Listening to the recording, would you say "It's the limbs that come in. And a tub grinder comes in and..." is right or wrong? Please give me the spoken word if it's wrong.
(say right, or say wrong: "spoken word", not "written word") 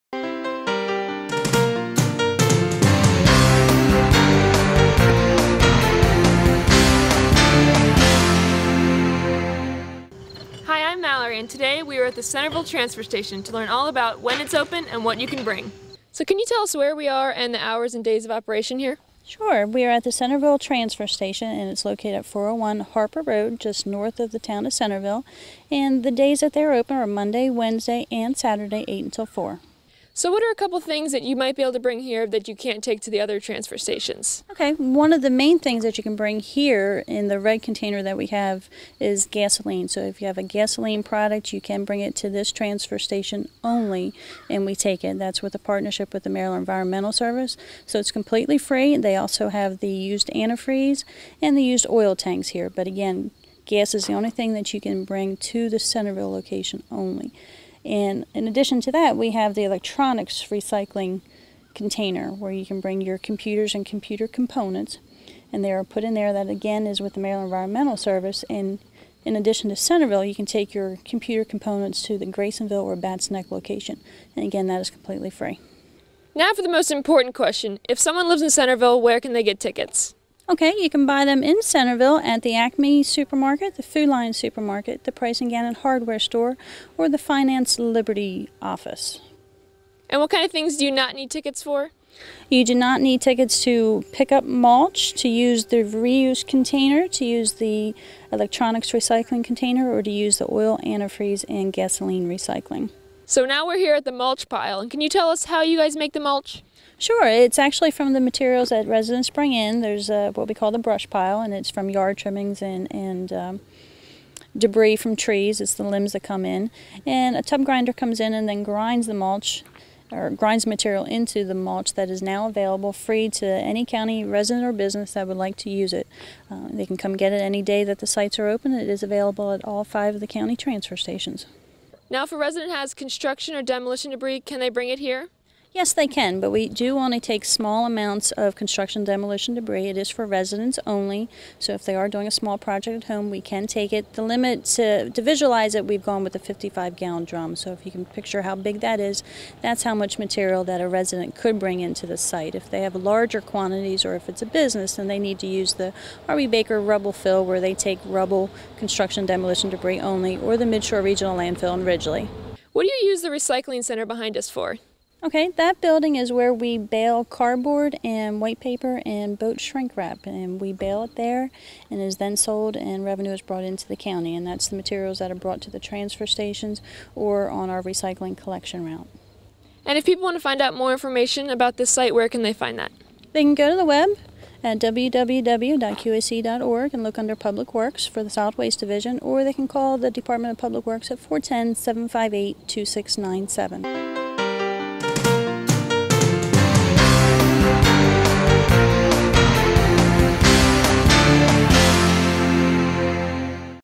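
right.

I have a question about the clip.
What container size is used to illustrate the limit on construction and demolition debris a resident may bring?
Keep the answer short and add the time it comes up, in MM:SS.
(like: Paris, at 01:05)
55 gallon drum, at 02:26.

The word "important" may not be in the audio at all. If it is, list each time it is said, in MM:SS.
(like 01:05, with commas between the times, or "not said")
01:16.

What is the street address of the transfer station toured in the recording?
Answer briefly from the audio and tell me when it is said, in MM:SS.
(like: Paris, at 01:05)
401 Harper Road, at 00:22.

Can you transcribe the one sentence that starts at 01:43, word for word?
So now we're here at the mulch pile, and can you tell us how you guys make the mulch?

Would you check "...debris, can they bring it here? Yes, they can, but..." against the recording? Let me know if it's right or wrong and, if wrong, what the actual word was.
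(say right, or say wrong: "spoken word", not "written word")
right.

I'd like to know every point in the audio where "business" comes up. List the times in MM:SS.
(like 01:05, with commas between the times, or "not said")
02:04, 02:34.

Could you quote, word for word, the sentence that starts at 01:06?
That again is with the Maryland Environmental Service.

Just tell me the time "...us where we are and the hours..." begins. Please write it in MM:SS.
00:16.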